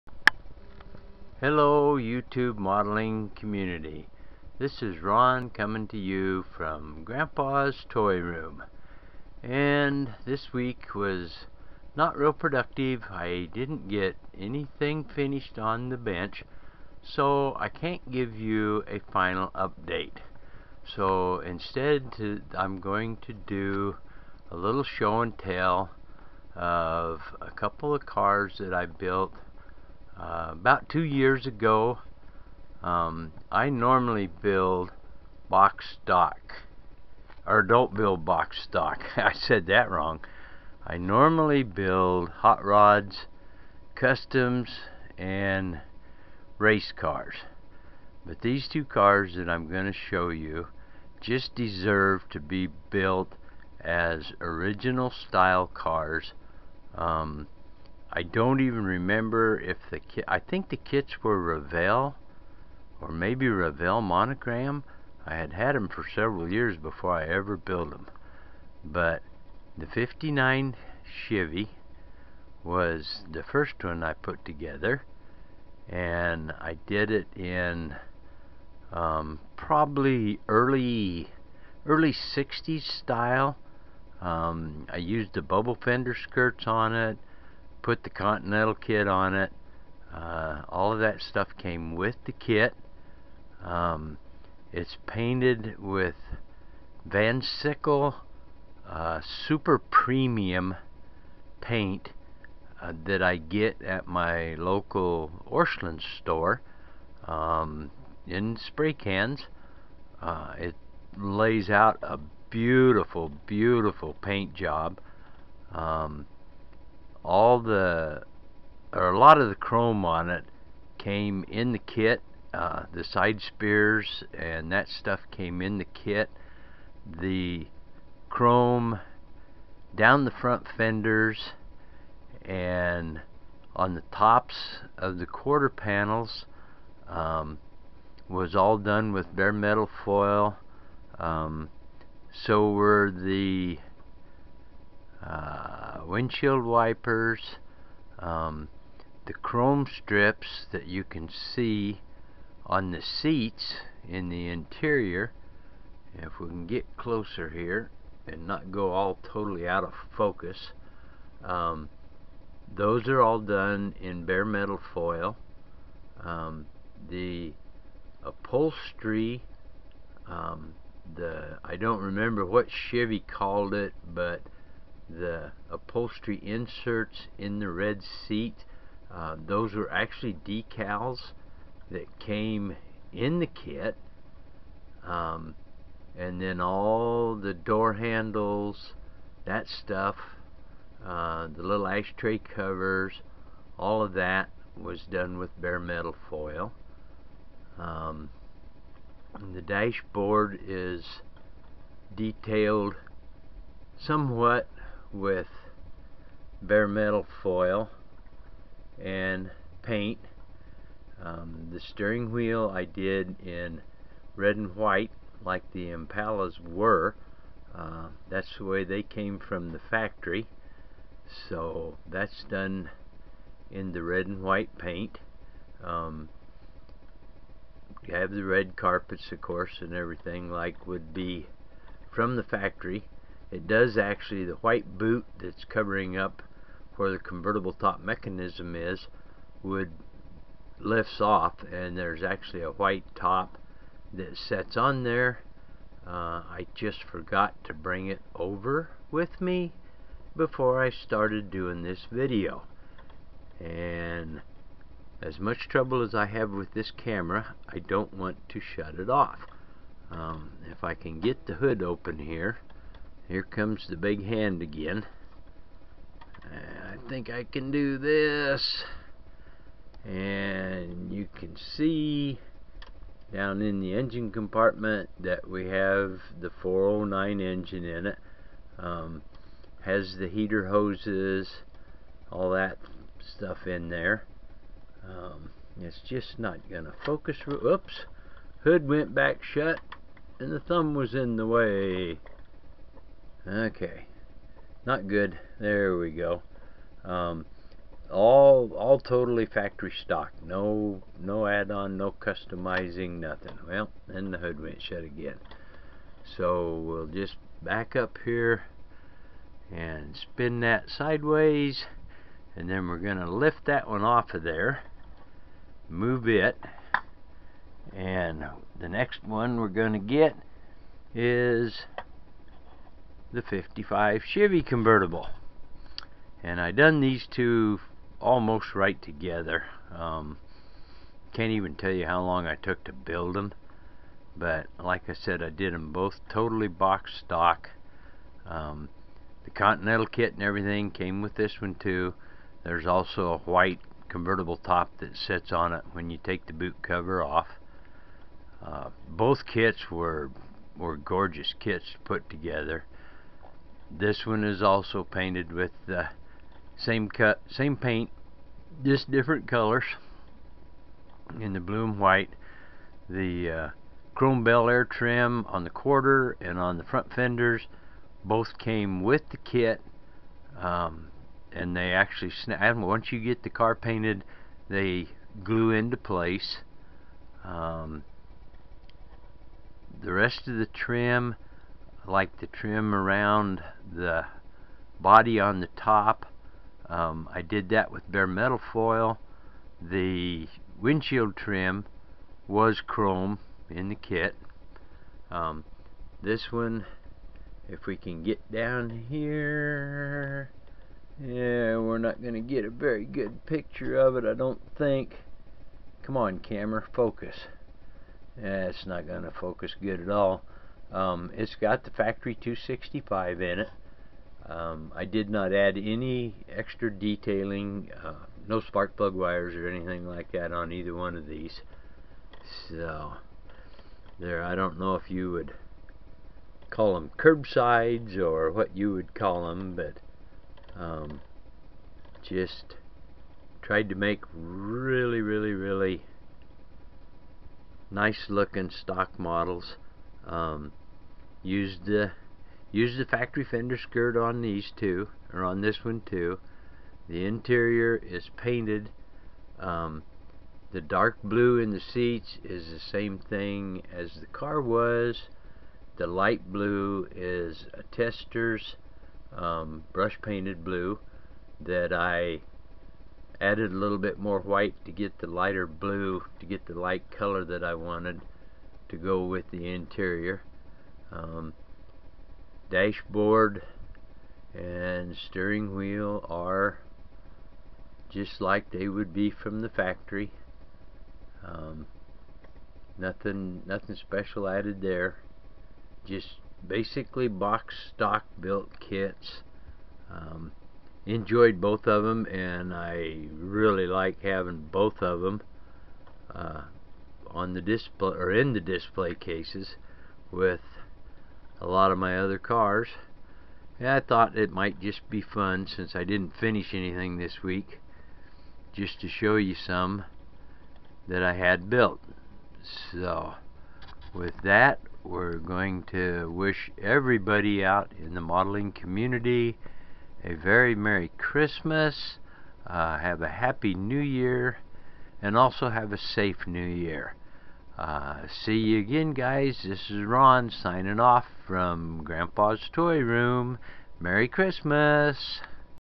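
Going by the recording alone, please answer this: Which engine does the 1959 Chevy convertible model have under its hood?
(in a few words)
409.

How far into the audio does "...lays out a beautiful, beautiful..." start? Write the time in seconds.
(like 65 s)
111 s.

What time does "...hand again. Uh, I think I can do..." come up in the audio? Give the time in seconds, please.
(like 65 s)
264 s.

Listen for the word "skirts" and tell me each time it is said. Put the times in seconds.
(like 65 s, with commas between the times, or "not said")
86 s, 443 s.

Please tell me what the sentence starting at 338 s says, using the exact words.
Um, the Continental kit and everything came with this one too.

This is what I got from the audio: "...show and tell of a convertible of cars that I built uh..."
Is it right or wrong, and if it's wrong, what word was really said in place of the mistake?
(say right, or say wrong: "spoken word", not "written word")
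wrong: "couple", not "convertible".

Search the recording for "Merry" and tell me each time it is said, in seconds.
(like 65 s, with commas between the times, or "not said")
520 s, 533 s.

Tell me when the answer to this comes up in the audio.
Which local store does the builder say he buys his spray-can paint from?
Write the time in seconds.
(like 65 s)
105 s.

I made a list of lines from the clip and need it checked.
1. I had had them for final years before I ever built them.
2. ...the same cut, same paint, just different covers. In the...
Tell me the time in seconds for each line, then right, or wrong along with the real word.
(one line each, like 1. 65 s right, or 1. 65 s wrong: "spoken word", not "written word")
1. 65 s wrong: "several", not "final"
2. 355 s wrong: "colors", not "covers".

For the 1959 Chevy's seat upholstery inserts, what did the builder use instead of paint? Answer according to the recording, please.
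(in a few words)
Decals.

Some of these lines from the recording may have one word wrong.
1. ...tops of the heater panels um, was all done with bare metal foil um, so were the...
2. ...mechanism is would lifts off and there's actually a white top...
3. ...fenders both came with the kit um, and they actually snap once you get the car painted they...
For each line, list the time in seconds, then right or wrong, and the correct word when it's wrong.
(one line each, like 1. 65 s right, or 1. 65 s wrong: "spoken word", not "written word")
1. 134 s wrong: "quarter", not "heater"
2. 237 s right
3. 367 s right.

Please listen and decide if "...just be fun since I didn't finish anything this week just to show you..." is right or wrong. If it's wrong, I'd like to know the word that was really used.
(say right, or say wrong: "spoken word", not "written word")
right.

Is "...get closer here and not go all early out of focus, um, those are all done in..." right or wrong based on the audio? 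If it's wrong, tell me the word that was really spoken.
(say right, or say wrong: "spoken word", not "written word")
wrong: "totally", not "early".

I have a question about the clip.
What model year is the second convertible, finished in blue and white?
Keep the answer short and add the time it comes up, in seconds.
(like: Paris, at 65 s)
1955, at 323 s.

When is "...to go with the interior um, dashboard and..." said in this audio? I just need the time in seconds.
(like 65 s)
468 s.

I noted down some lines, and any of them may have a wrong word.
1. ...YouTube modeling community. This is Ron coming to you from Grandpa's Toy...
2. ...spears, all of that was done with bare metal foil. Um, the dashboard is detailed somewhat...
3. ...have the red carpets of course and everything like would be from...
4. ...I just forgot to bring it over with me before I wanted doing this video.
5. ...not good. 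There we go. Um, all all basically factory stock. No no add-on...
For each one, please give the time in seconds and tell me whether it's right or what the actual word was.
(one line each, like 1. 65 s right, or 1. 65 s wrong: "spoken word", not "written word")
1. 1 s right
2. 192 s wrong: "covers", not "spears"
3. 228 s right
4. 246 s wrong: "started", not "wanted"
5. 294 s wrong: "totally", not "basically".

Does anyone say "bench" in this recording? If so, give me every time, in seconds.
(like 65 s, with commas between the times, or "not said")
15 s.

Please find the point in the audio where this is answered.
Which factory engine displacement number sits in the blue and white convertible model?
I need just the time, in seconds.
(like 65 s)
412 s.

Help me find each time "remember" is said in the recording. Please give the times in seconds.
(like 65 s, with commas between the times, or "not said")
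58 s, 172 s.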